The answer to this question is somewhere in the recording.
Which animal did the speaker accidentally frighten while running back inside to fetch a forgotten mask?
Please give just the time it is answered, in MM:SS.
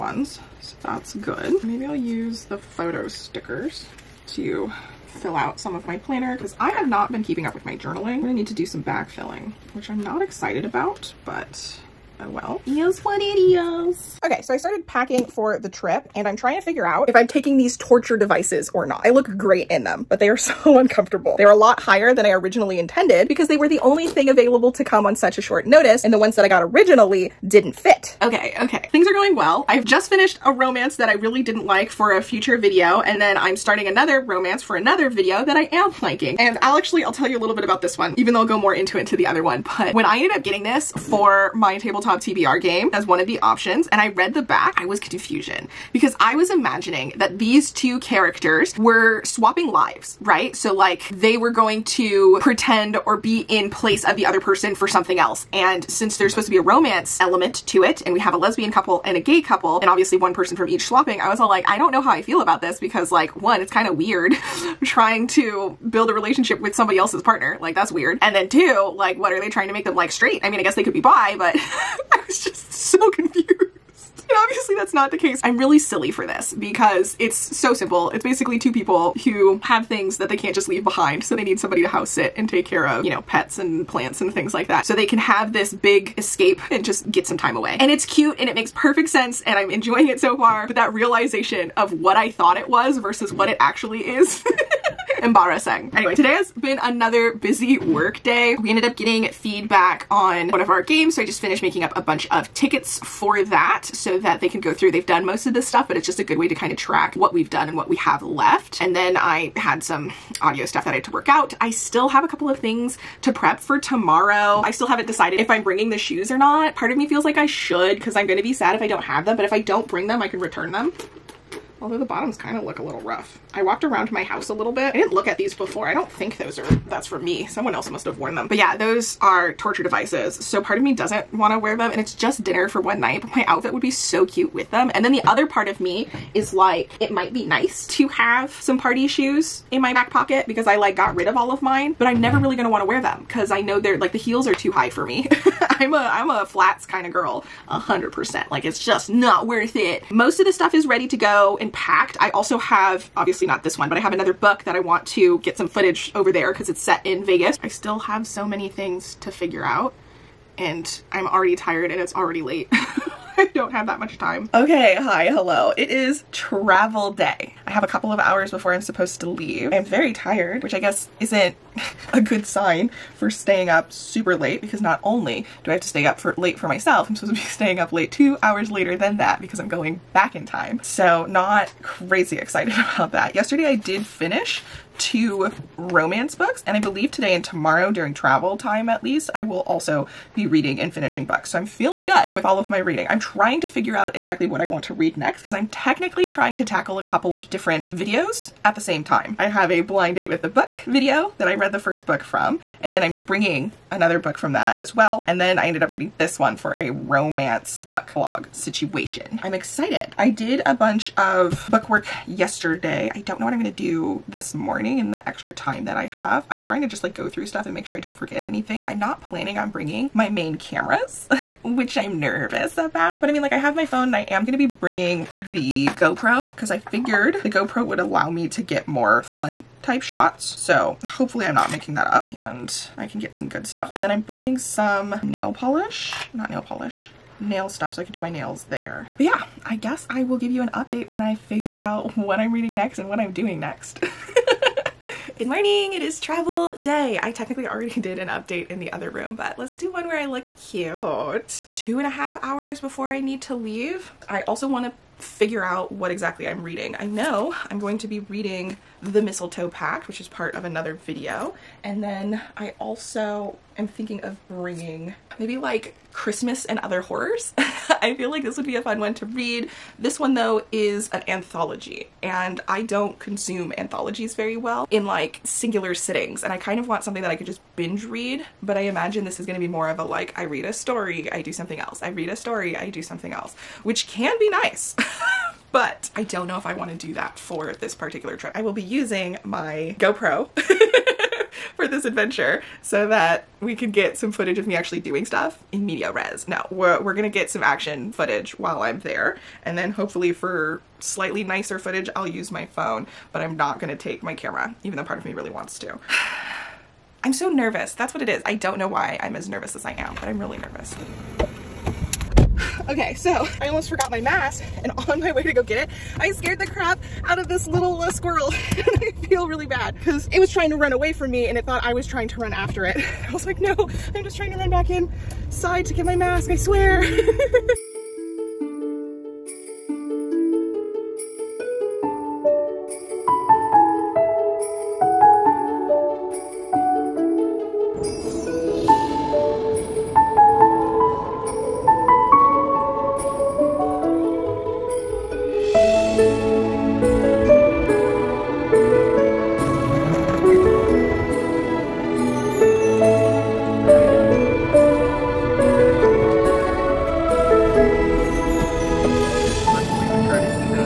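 05:18.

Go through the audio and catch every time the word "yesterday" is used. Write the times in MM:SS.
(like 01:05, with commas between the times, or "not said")
03:03, 03:32.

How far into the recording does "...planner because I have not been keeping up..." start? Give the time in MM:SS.
00:05.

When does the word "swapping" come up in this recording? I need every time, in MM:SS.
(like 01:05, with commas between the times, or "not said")
00:49, 01:00.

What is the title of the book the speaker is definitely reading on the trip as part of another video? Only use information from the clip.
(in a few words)
The Mistletoe Pact.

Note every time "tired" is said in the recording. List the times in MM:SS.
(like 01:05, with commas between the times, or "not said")
02:41, 02:50.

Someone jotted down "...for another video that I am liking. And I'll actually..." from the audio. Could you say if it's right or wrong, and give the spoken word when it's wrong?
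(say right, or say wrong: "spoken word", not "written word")
right.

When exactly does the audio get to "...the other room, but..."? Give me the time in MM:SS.
04:08.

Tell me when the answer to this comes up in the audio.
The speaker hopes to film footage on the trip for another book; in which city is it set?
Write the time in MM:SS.
02:37.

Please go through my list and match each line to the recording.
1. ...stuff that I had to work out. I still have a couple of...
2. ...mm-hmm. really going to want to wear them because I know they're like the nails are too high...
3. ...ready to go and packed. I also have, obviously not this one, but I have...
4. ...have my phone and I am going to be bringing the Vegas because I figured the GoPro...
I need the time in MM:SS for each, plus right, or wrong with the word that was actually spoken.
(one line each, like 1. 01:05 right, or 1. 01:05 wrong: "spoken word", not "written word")
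1. 01:50 right
2. 02:22 wrong: "heels", not "nails"
3. 02:30 right
4. 03:43 wrong: "GoPro", not "Vegas".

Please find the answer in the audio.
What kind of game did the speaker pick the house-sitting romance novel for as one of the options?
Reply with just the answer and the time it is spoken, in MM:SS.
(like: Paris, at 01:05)
tabletop TBR game, at 00:41.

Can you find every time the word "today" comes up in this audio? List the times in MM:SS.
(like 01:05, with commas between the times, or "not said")
01:36, 03:07.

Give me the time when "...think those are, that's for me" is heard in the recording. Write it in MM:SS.
02:06.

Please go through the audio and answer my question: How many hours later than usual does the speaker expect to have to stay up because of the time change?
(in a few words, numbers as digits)
2.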